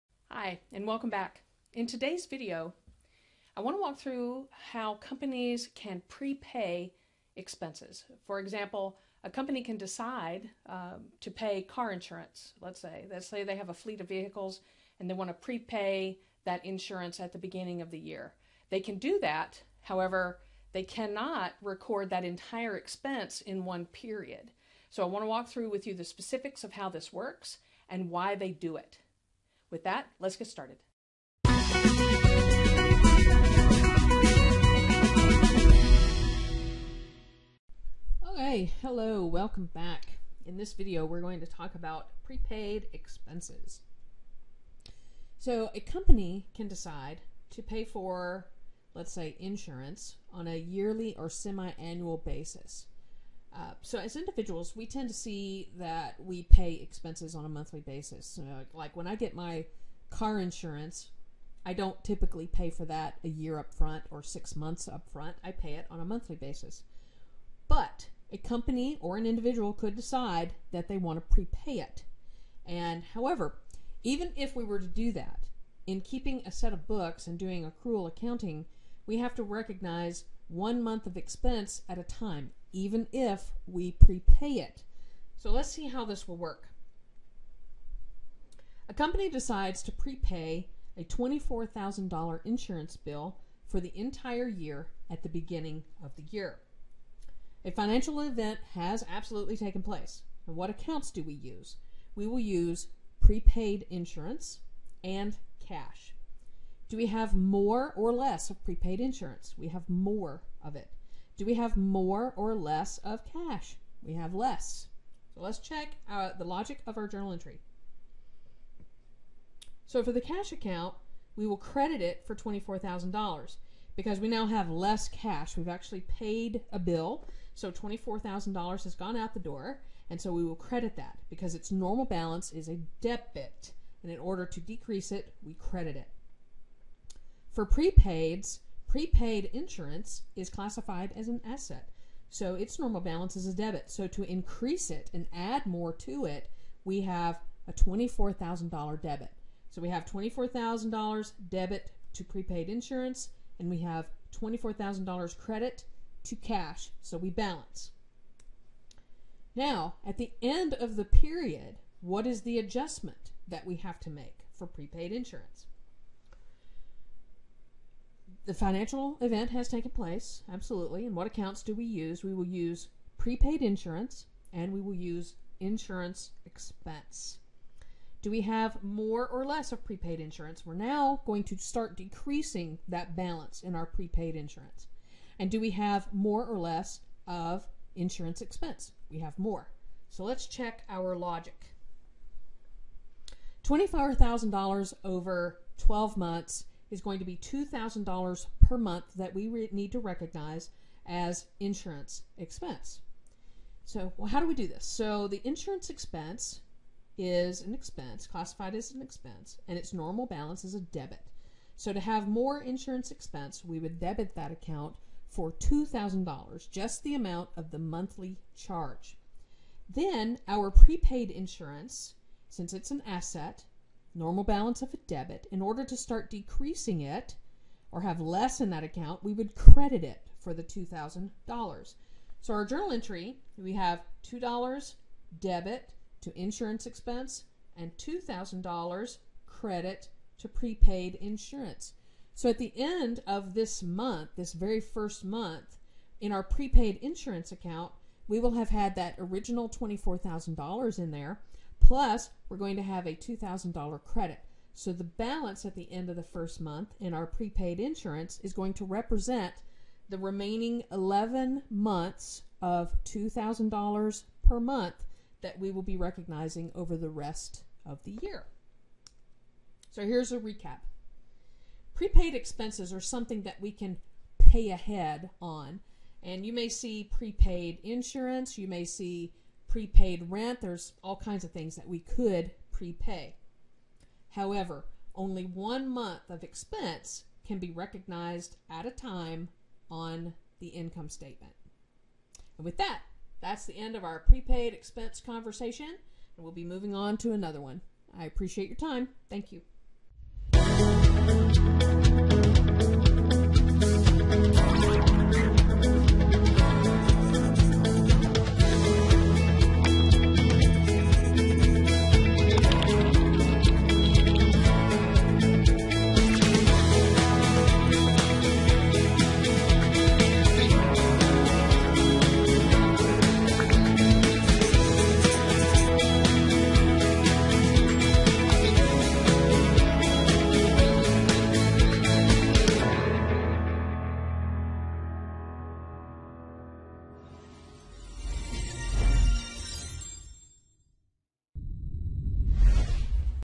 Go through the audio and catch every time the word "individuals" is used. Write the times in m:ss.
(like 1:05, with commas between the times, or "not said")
0:54, 1:09.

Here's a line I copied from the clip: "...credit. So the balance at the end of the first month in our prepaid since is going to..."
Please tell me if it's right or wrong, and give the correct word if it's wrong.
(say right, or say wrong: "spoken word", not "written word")
wrong: "insurance", not "since".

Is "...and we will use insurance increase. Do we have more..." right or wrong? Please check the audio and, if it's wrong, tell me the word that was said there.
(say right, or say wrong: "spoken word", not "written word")
wrong: "expense", not "increase".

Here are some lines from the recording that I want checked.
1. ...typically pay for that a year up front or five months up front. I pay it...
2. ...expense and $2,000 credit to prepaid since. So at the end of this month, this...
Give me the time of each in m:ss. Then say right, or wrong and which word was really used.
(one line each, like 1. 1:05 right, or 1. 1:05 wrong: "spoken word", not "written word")
1. 1:02 wrong: "six", not "five"
2. 3:56 wrong: "insurance", not "since".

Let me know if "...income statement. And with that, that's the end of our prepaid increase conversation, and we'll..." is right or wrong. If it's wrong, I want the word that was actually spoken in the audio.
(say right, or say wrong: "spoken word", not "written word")
wrong: "expense", not "increase".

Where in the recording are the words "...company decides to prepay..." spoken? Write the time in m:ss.
1:28.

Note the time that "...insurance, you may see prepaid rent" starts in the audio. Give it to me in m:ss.
4:37.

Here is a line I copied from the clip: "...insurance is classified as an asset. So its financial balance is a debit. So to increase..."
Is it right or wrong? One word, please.
wrong.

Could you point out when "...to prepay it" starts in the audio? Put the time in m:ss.
1:11.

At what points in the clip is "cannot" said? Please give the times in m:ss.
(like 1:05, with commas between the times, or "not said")
0:20.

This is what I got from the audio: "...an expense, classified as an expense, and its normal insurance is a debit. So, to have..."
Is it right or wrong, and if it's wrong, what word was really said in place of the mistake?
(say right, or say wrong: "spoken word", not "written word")
wrong: "balance", not "insurance".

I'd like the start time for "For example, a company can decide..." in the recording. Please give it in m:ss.
0:08.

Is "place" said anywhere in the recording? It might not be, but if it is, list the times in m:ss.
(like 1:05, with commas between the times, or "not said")
1:39, 2:49.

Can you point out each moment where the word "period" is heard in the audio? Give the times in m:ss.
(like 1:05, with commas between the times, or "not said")
0:23, 2:41.